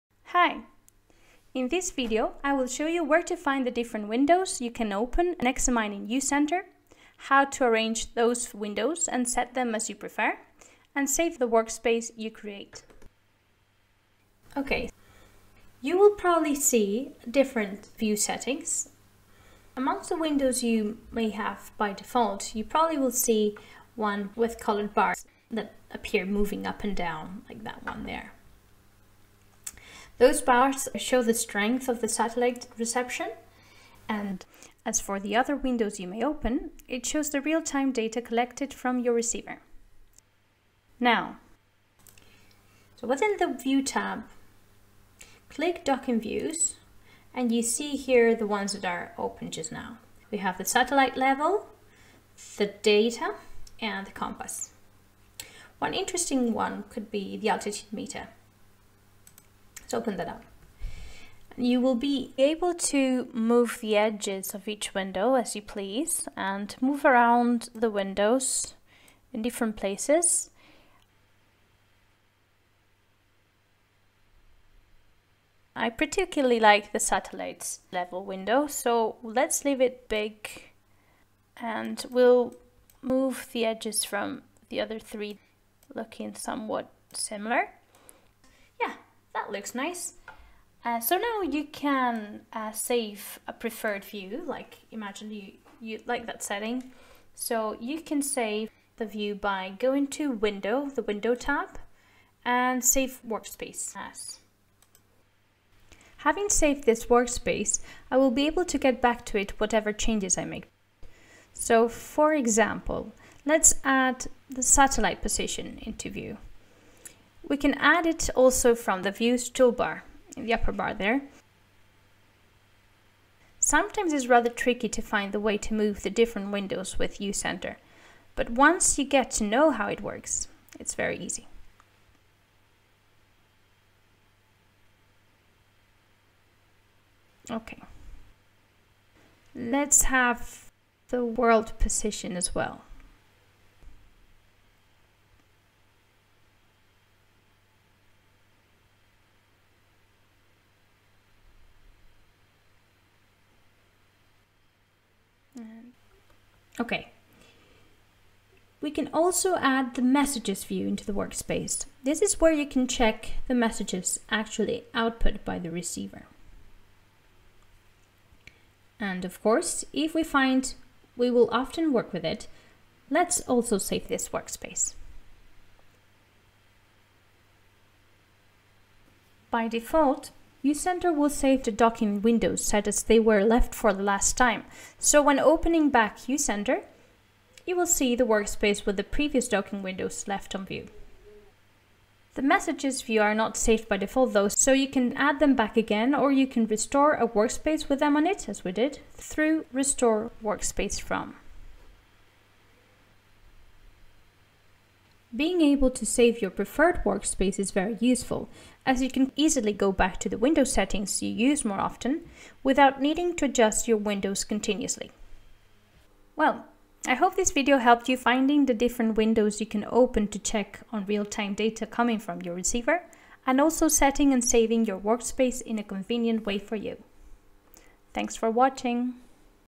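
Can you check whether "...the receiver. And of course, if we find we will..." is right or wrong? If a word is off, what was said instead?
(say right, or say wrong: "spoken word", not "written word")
right.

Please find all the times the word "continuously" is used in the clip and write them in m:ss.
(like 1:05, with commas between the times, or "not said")
3:34.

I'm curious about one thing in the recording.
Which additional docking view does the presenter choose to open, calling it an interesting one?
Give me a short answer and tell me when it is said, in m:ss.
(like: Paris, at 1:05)
altitude meter, at 0:57.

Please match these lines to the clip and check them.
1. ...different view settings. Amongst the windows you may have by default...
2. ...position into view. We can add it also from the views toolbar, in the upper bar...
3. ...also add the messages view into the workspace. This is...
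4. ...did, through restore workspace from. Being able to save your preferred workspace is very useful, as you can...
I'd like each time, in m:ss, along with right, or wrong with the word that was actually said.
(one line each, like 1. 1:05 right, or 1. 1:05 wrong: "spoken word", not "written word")
1. 0:17 right
2. 1:55 right
3. 2:39 right
4. 3:18 right.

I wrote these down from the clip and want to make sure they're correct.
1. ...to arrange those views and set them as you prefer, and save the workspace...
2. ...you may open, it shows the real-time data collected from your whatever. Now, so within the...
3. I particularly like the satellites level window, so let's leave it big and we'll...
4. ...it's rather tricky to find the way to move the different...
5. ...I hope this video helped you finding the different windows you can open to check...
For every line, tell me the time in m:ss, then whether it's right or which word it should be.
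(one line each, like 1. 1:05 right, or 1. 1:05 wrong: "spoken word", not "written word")
1. 0:07 wrong: "windows", not "views"
2. 0:35 wrong: "receiver", not "whatever"
3. 1:15 right
4. 2:04 right
5. 3:37 right.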